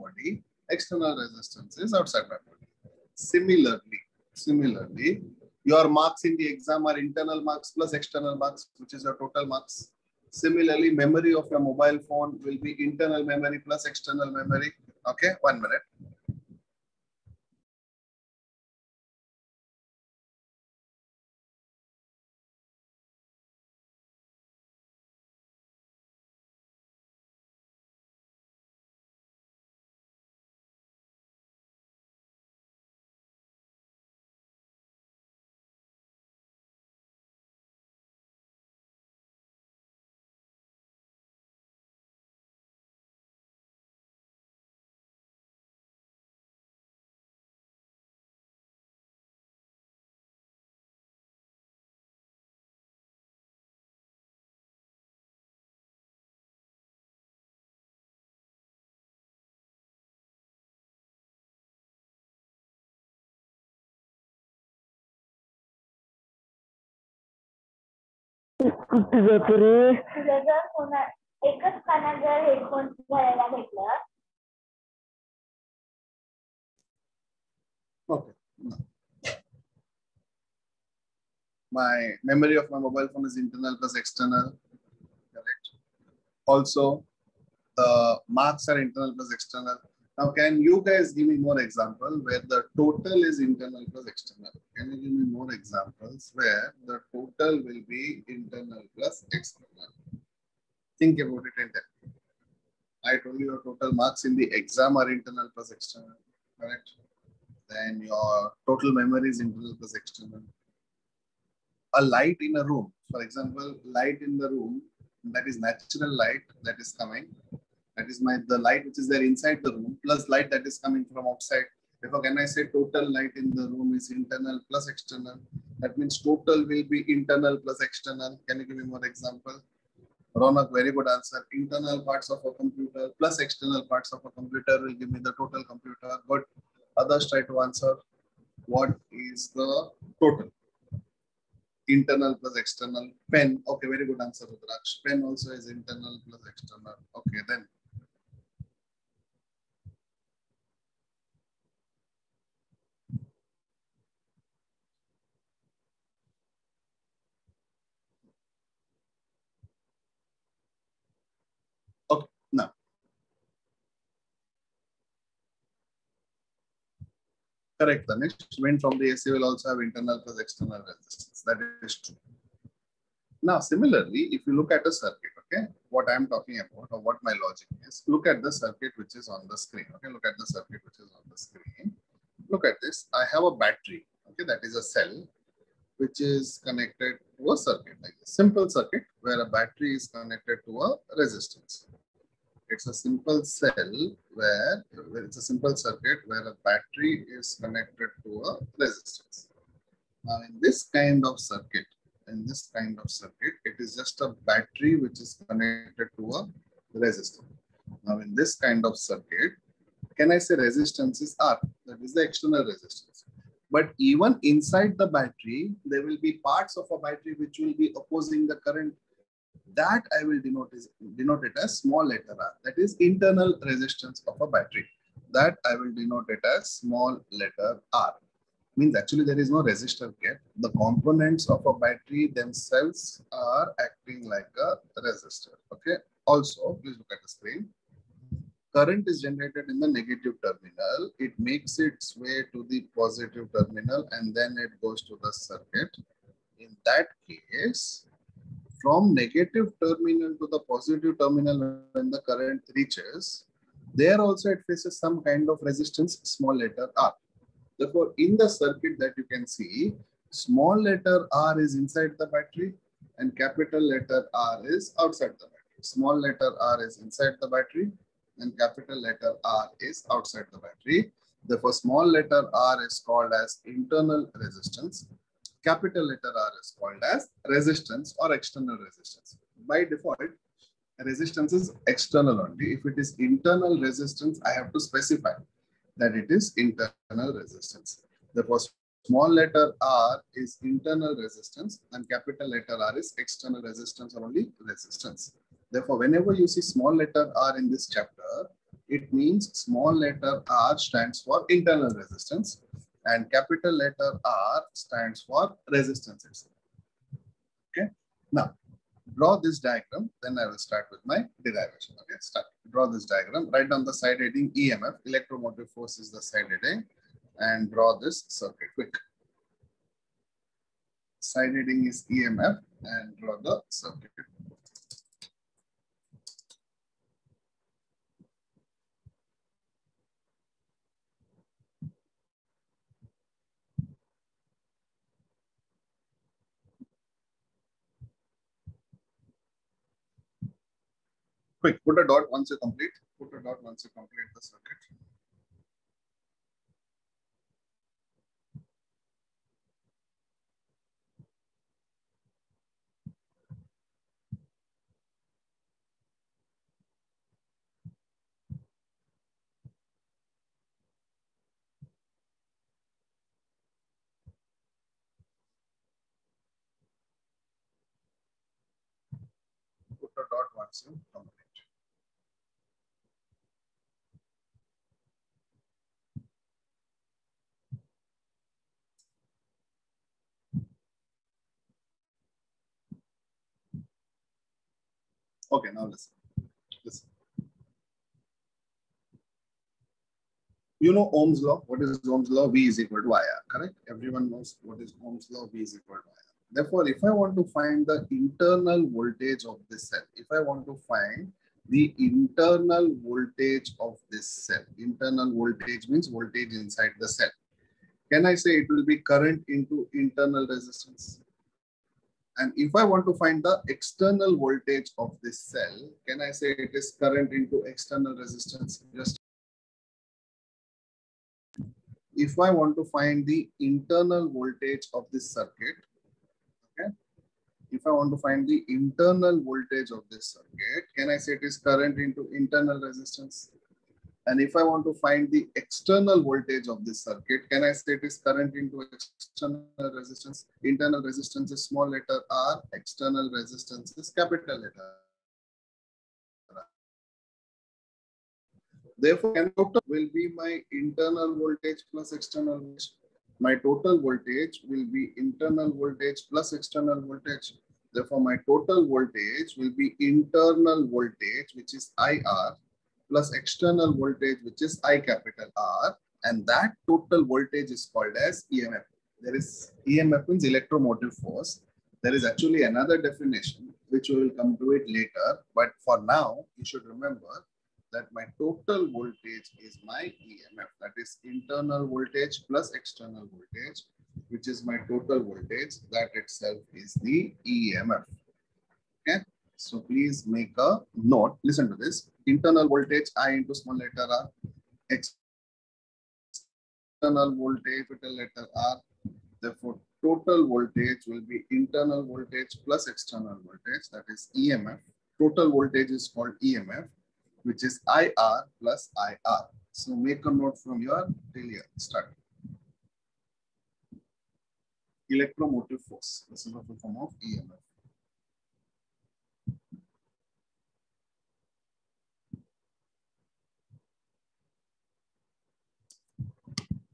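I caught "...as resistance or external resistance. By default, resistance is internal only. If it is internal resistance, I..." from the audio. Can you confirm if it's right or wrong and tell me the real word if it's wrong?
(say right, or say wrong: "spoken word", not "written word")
wrong: "external", not "internal".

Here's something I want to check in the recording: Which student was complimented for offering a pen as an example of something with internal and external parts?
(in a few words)
Rudraksh.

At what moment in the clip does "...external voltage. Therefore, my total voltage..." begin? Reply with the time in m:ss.
7:36.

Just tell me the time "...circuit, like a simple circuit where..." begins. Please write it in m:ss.
3:07.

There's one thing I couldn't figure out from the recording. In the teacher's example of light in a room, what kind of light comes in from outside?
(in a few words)
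Natural light.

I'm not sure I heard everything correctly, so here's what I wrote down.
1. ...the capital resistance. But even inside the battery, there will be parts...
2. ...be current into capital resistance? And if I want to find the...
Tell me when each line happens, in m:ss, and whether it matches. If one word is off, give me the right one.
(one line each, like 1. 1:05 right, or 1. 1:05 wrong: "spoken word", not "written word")
1. 3:32 wrong: "external", not "capital"
2. 6:48 wrong: "internal", not "capital".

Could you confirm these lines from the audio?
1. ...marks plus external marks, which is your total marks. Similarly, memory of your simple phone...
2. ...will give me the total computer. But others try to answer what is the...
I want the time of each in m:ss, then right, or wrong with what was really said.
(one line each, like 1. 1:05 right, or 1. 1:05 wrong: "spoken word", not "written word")
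1. 0:07 wrong: "mobile", not "simple"
2. 2:14 right.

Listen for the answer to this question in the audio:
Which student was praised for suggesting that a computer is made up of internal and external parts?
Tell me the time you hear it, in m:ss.
2:10.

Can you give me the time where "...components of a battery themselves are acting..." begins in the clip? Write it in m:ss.
3:50.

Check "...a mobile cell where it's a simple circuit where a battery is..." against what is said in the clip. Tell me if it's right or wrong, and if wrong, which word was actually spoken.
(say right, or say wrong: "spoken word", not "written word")
wrong: "simple", not "mobile".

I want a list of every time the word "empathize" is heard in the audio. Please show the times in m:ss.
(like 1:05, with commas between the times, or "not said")
not said.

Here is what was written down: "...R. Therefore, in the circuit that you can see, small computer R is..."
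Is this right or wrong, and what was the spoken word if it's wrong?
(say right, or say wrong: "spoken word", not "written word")
wrong: "letter", not "computer".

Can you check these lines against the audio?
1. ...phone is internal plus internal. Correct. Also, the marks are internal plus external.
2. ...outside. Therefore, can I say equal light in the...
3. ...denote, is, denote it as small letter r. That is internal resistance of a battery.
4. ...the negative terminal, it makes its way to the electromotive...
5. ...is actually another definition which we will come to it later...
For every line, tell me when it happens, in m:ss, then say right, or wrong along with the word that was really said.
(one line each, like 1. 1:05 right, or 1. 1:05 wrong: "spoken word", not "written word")
1. 1:23 wrong: "external", not "internal"
2. 2:01 wrong: "total", not "equal"
3. 3:40 right
4. 3:59 wrong: "positive", not "electromotive"
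5. 7:52 right.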